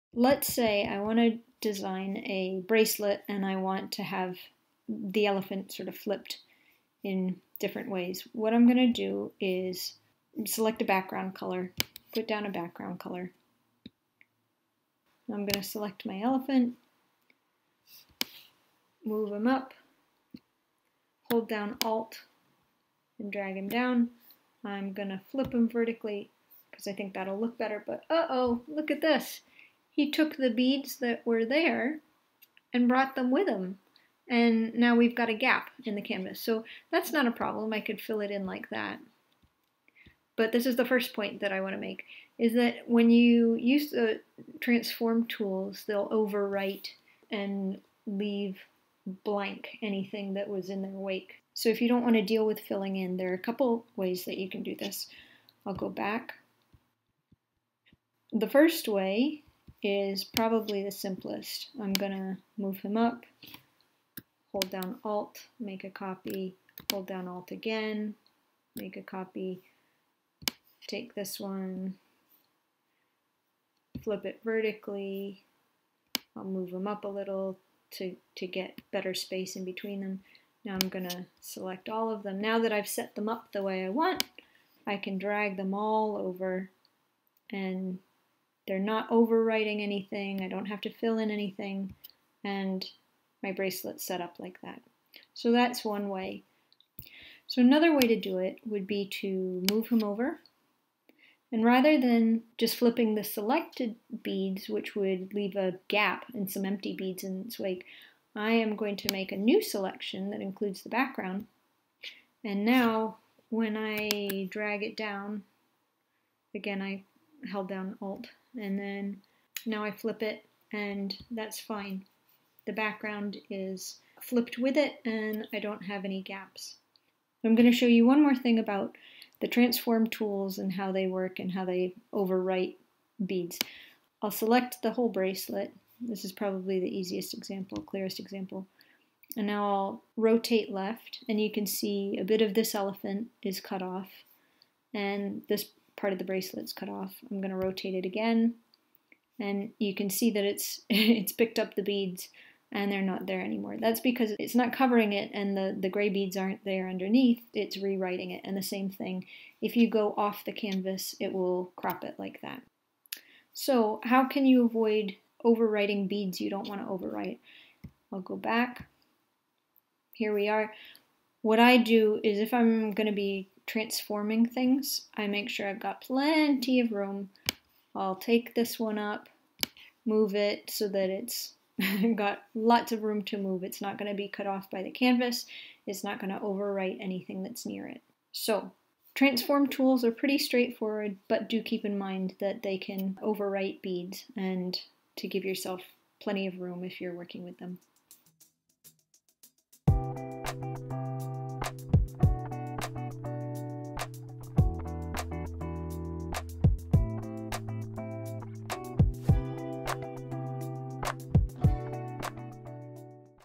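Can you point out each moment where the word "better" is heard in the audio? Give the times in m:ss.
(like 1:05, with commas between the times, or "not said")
0:27, 1:18.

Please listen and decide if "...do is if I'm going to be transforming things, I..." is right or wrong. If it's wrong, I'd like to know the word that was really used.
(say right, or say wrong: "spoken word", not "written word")
right.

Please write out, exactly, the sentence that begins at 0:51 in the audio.
So if you don't want to deal with filling in, there are a couple ways that you can do this.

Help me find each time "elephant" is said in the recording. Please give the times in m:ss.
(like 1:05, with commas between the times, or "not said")
0:05, 0:16, 2:22.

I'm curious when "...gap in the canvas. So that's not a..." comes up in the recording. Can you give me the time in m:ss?
0:35.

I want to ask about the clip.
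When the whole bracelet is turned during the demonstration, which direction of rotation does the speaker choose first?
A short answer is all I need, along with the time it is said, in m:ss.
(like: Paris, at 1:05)
Left, at 2:20.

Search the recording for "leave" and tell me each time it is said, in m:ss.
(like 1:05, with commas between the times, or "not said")
0:48, 1:45.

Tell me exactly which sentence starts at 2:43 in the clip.
So how can you avoid overwriting beads you don't want to overwrite?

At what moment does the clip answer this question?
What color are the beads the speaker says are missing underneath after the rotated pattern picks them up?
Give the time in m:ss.
2:35.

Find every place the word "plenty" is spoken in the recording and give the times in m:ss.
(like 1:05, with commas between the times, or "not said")
2:56, 3:16.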